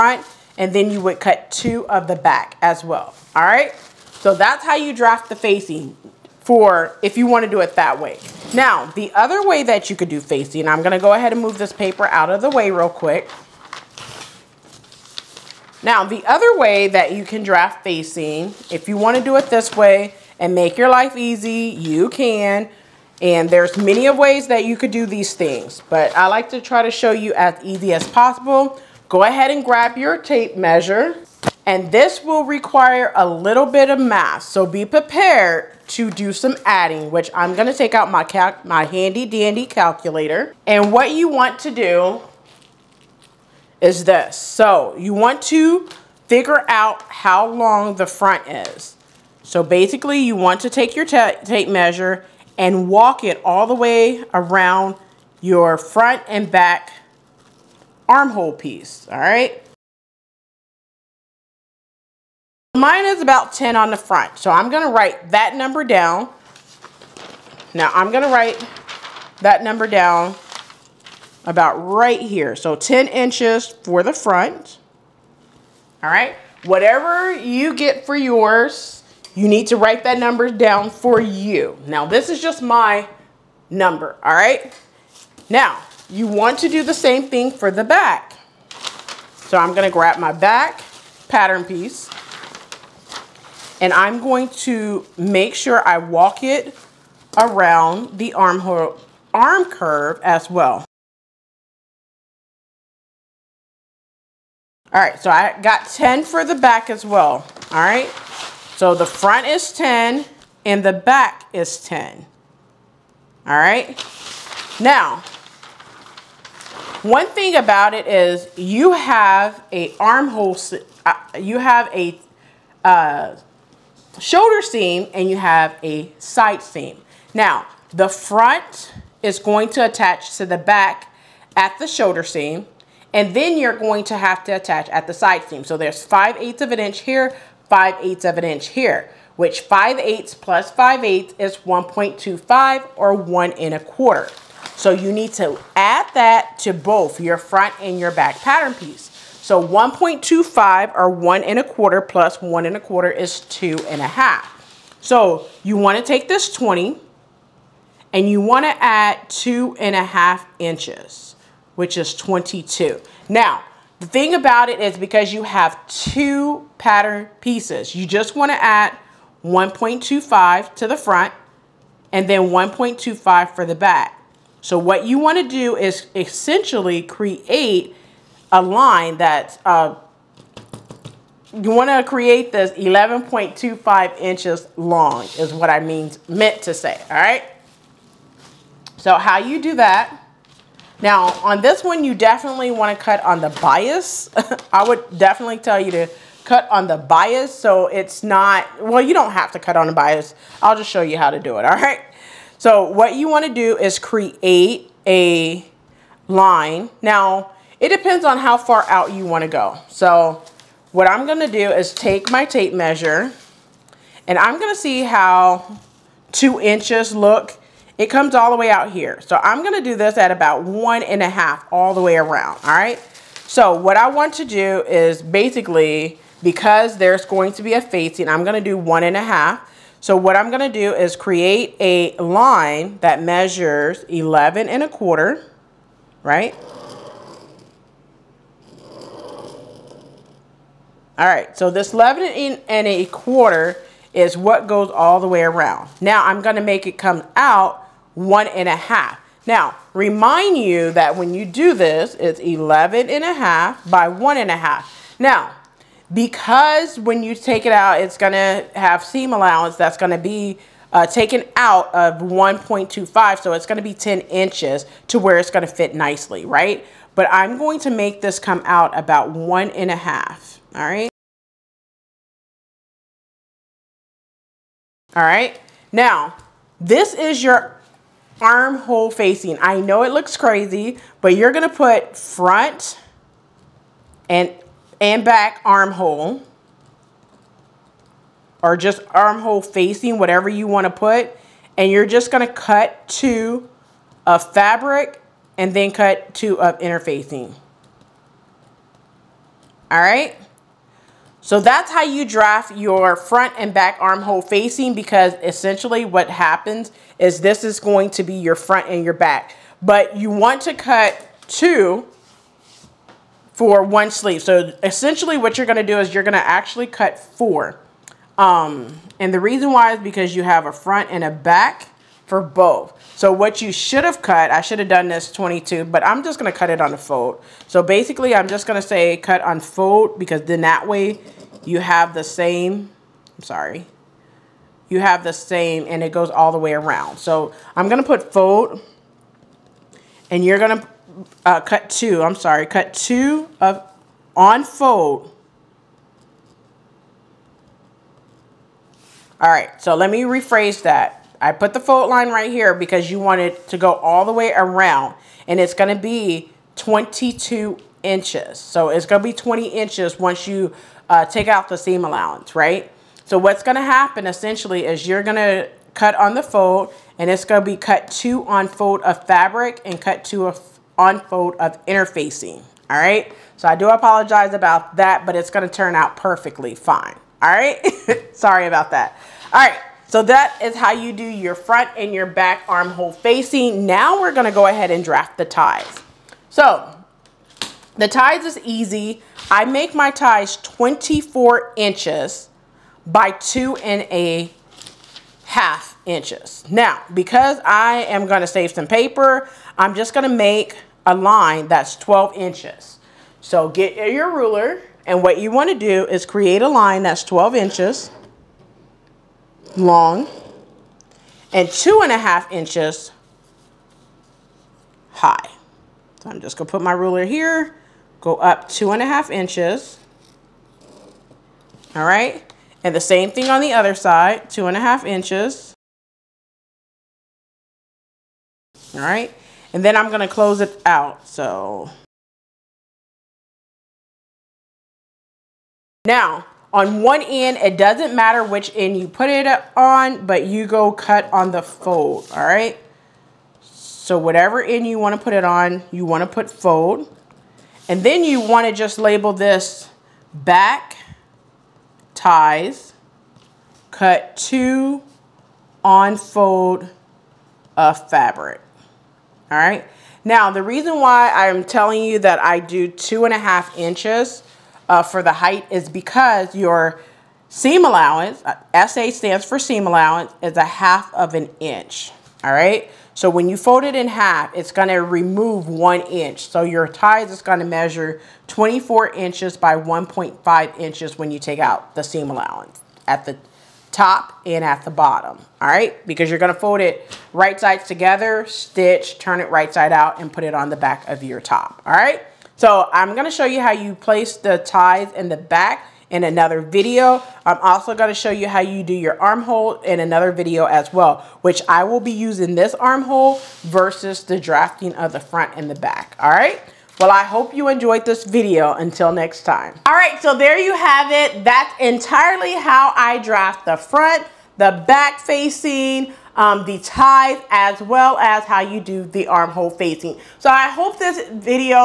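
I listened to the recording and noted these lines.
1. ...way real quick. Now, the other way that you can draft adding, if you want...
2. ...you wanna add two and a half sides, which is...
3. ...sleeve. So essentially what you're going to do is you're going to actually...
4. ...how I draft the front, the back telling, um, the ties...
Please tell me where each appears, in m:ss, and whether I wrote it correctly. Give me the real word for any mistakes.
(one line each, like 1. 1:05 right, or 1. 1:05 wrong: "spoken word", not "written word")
1. 0:12 wrong: "facing", not "adding"
2. 2:38 wrong: "inches", not "sides"
3. 5:14 right
4. 8:32 wrong: "facing", not "telling".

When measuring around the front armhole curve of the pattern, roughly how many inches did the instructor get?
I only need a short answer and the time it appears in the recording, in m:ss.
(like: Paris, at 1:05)
10, at 1:02.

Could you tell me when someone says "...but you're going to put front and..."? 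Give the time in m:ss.
4:41.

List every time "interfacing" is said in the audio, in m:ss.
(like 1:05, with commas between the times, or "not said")
4:56, 6:11.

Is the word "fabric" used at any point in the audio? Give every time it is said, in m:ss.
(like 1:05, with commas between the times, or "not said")
4:54, 6:09, 7:38.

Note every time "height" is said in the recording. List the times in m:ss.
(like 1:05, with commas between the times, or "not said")
7:45.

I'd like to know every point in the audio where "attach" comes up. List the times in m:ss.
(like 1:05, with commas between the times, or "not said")
2:09, 2:14.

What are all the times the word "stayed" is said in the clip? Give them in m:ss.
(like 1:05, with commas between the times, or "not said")
not said.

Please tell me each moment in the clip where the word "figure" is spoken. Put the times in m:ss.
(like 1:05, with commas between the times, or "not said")
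0:46.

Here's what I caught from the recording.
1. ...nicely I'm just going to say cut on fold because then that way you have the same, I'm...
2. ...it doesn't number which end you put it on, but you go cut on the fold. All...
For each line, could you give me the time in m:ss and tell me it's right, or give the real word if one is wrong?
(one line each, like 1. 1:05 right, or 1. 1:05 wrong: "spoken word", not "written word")
1. 5:27 wrong: "basically", not "nicely"
2. 7:17 wrong: "matter", not "number".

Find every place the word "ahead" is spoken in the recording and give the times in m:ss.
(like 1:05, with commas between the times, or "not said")
0:11, 0:29, 6:24.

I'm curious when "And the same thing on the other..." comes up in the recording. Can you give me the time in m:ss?
7:02.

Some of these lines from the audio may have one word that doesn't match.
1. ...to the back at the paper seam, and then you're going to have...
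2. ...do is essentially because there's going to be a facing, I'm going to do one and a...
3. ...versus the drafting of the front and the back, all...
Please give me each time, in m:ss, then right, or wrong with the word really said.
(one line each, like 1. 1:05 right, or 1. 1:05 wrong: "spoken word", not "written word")
1. 2:10 wrong: "shoulder", not "paper"
2. 3:44 wrong: "basically", not "essentially"
3. 8:23 right.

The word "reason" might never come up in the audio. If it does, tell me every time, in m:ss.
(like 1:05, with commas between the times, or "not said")
5:19, 7:40.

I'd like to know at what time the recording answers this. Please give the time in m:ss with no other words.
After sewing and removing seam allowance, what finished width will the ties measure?
7:59.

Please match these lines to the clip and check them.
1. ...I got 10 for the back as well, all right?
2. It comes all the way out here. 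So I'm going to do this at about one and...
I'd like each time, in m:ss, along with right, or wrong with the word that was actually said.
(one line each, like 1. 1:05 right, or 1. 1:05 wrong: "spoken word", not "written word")
1. 1:45 right
2. 3:37 right.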